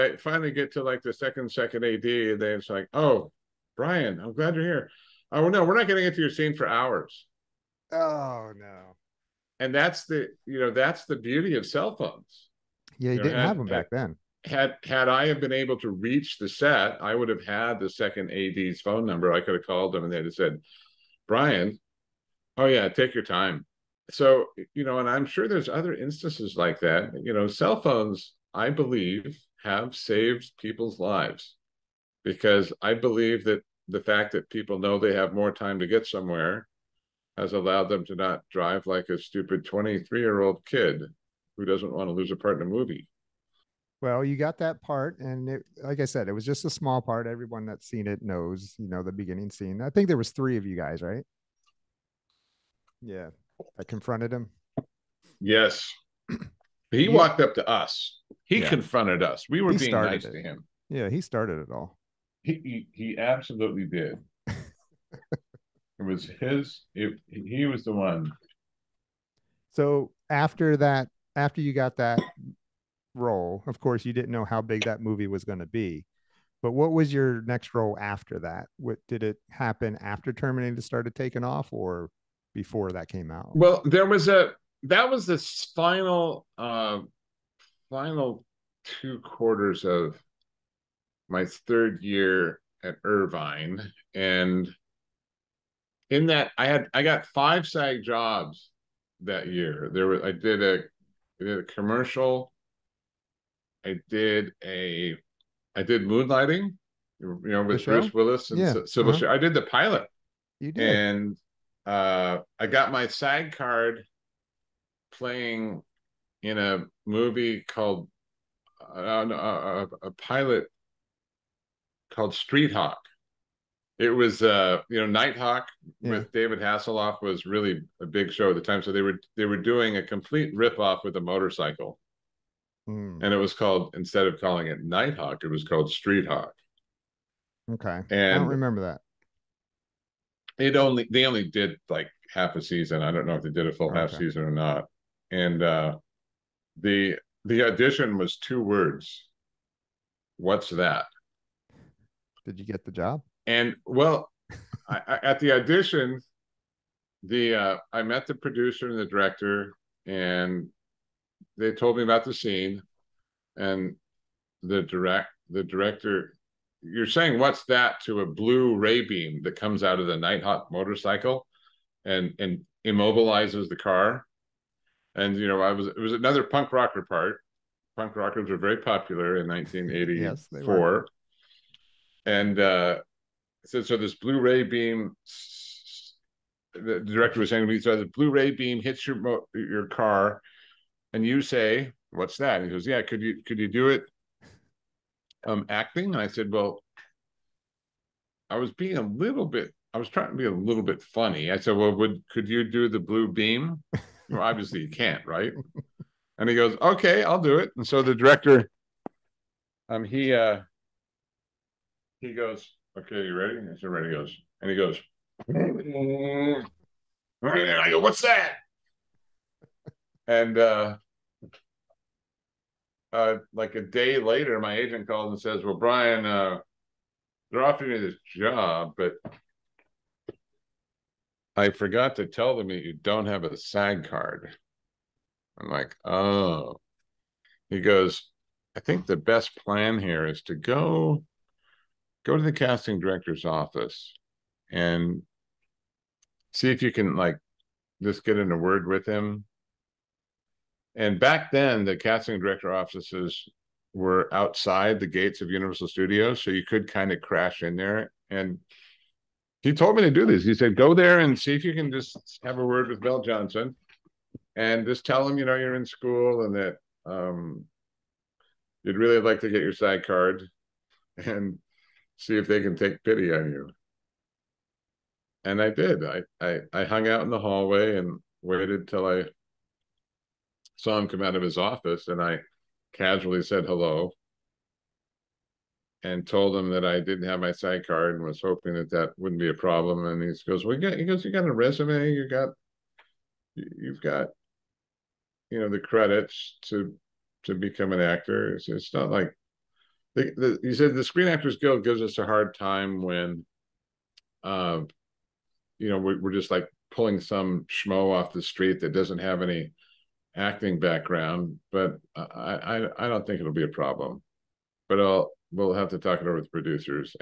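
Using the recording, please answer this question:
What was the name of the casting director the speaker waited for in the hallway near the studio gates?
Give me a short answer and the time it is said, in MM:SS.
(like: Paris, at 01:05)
Bill Johnson, at 04:22.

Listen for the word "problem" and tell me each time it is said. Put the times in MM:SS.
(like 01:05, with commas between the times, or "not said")
04:49, 05:13.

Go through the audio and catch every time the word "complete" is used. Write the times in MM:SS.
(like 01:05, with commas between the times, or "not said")
02:10.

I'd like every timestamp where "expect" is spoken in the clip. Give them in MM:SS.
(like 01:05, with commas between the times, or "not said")
not said.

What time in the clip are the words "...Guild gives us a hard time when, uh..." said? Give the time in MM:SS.
05:01.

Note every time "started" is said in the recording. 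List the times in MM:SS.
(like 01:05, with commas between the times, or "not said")
01:01, 01:20.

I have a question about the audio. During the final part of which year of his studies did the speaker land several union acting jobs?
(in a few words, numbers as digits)
third year.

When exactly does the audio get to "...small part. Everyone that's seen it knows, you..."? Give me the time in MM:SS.
00:46.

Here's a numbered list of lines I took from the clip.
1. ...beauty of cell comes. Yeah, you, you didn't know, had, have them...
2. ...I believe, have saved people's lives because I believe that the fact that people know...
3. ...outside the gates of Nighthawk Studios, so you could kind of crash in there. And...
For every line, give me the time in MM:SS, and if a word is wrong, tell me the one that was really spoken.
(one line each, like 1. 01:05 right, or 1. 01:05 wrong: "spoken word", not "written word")
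1. 00:11 wrong: "phones", not "comes"
2. 00:28 right
3. 04:14 wrong: "Universal", not "Nighthawk".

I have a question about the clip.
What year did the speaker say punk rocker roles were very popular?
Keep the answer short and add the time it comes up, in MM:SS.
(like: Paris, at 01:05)
1984, at 02:59.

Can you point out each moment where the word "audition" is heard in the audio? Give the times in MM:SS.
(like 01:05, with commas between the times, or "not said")
02:27, 02:35.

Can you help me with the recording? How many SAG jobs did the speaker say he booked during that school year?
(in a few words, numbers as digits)
5.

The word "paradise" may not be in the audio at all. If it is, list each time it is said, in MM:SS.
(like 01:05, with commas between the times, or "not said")
not said.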